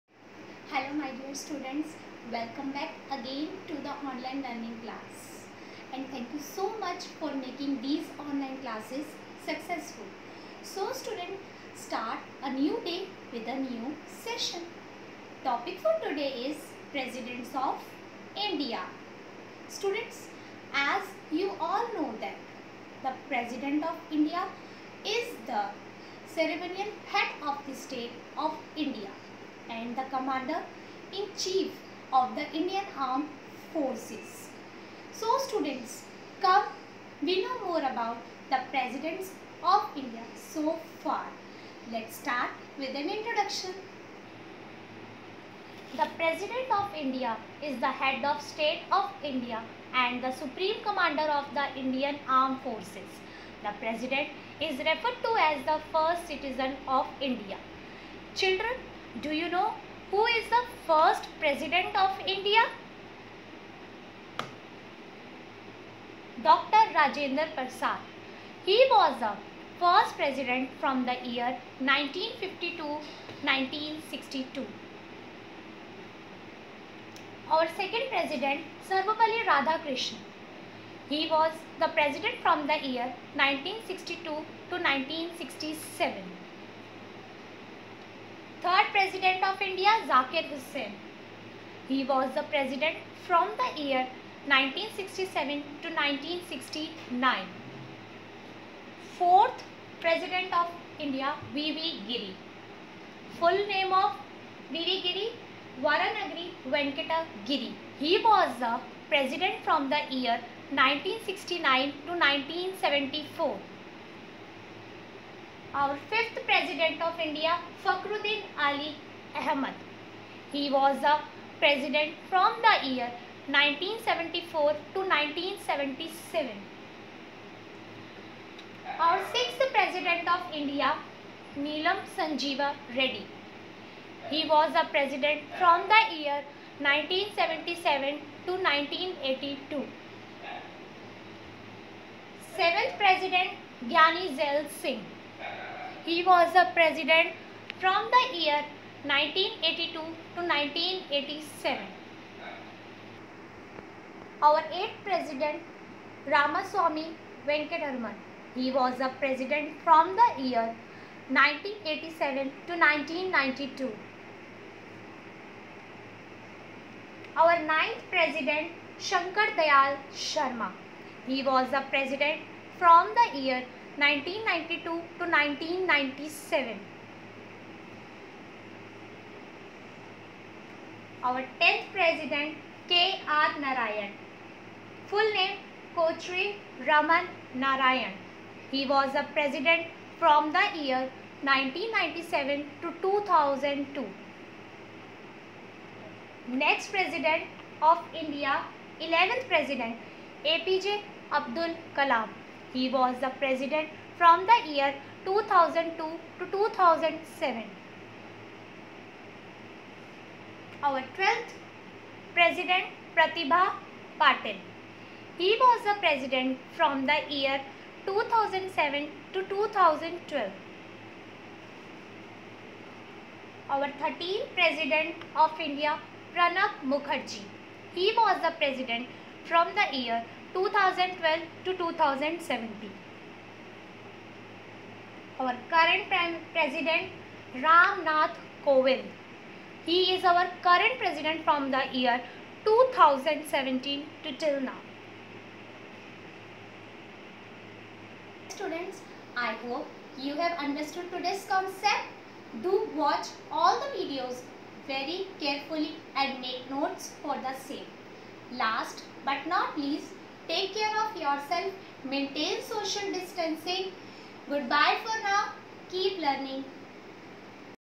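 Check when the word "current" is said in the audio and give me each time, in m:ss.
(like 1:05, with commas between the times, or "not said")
3:55, 4:00.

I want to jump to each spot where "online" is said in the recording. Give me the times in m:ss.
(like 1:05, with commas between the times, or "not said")
0:04, 0:08.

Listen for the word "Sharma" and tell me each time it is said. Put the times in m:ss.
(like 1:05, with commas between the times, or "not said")
2:50.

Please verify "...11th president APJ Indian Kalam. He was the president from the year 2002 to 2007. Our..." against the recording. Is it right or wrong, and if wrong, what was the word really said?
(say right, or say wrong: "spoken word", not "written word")
wrong: "Abdul", not "Indian".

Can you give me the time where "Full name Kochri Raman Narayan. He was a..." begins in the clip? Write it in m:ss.
3:05.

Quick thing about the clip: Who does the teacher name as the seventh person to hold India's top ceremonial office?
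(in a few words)
Gyani Zail Singh.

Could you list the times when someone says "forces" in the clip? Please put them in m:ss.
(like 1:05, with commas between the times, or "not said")
0:33, 0:52.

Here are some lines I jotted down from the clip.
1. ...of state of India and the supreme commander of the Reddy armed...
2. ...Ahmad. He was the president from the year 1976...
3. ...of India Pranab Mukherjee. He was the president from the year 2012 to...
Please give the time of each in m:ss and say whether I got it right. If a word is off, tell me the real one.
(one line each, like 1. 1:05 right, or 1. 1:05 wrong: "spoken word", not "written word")
1. 0:48 wrong: "Indian", not "Reddy"
2. 1:59 wrong: "1974", not "1976"
3. 3:45 right.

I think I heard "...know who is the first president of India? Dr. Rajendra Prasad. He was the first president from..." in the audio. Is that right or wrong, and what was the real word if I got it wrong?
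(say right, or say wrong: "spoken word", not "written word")
right.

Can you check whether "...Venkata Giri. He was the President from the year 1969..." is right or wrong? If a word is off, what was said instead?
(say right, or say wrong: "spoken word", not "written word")
right.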